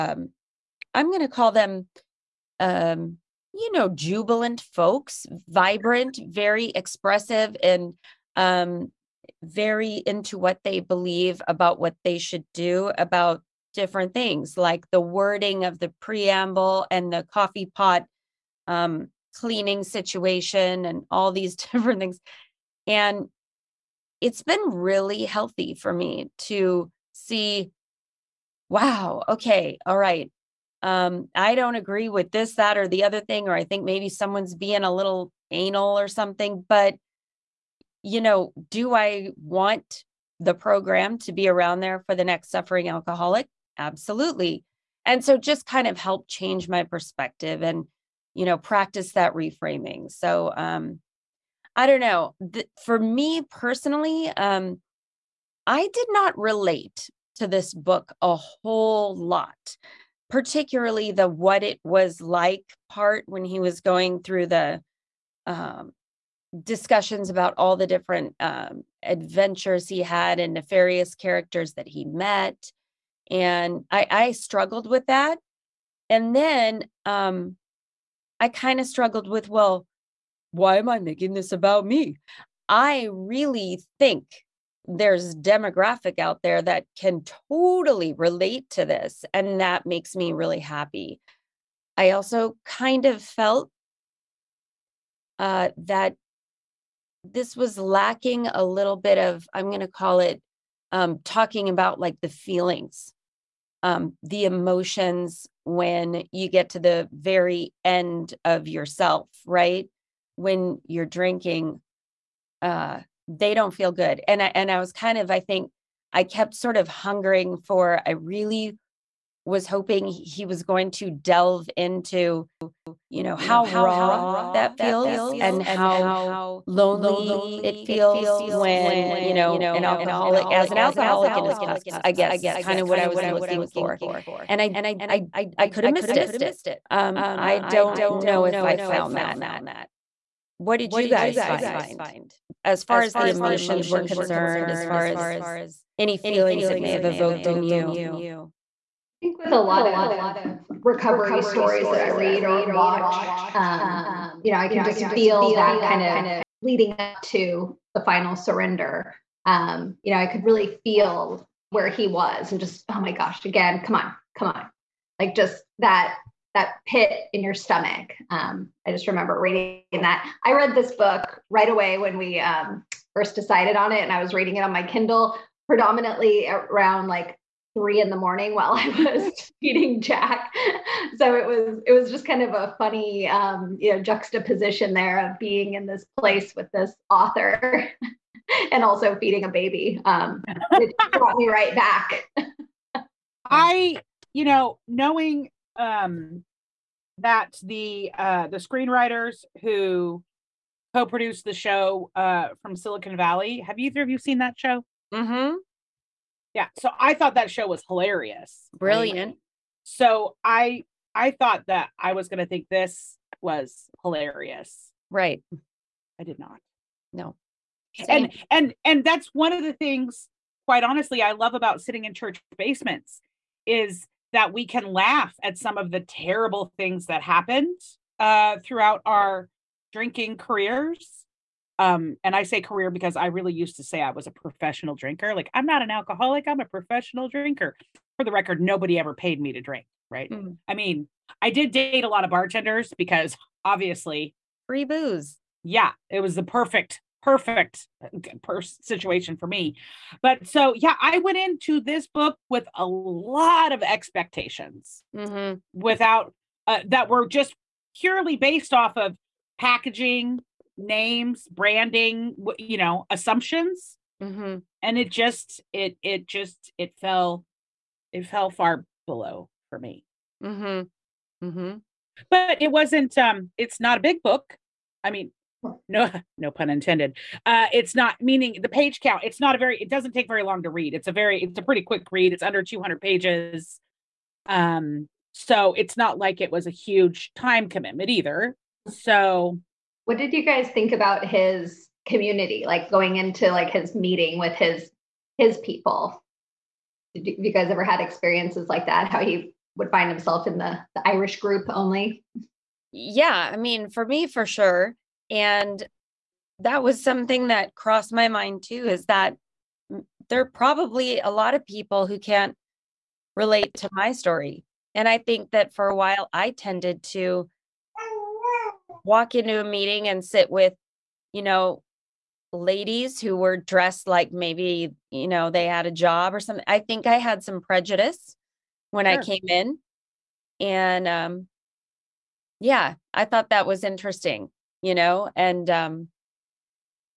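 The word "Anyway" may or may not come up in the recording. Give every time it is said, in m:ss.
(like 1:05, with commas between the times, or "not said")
3:29.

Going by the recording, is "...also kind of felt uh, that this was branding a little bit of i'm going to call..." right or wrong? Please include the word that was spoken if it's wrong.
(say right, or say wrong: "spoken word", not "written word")
wrong: "lacking", not "branding".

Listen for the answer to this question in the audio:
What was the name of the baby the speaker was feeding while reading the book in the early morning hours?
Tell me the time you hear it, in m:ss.
3:00.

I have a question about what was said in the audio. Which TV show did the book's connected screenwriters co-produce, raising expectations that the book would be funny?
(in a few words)
Silicon Valley.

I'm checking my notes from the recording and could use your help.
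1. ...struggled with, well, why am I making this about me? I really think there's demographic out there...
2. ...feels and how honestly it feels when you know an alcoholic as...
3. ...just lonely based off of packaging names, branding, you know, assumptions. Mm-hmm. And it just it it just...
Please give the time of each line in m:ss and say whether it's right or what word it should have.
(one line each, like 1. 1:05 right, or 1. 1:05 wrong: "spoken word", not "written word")
1. 1:18 right
2. 2:04 wrong: "lonely", not "honestly"
3. 4:17 wrong: "purely", not "lonely".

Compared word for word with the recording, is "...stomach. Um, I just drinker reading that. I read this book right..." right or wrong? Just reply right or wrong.
wrong.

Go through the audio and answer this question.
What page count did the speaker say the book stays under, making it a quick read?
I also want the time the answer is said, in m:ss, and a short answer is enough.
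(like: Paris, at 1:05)
200 pages, at 4:42.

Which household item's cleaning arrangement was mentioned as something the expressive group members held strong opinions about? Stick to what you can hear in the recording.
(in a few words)
coffee pot.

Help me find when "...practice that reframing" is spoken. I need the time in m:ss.
0:48.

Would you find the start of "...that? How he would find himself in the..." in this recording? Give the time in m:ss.
4:58.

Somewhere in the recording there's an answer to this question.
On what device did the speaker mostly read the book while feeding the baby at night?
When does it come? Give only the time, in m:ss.
2:54.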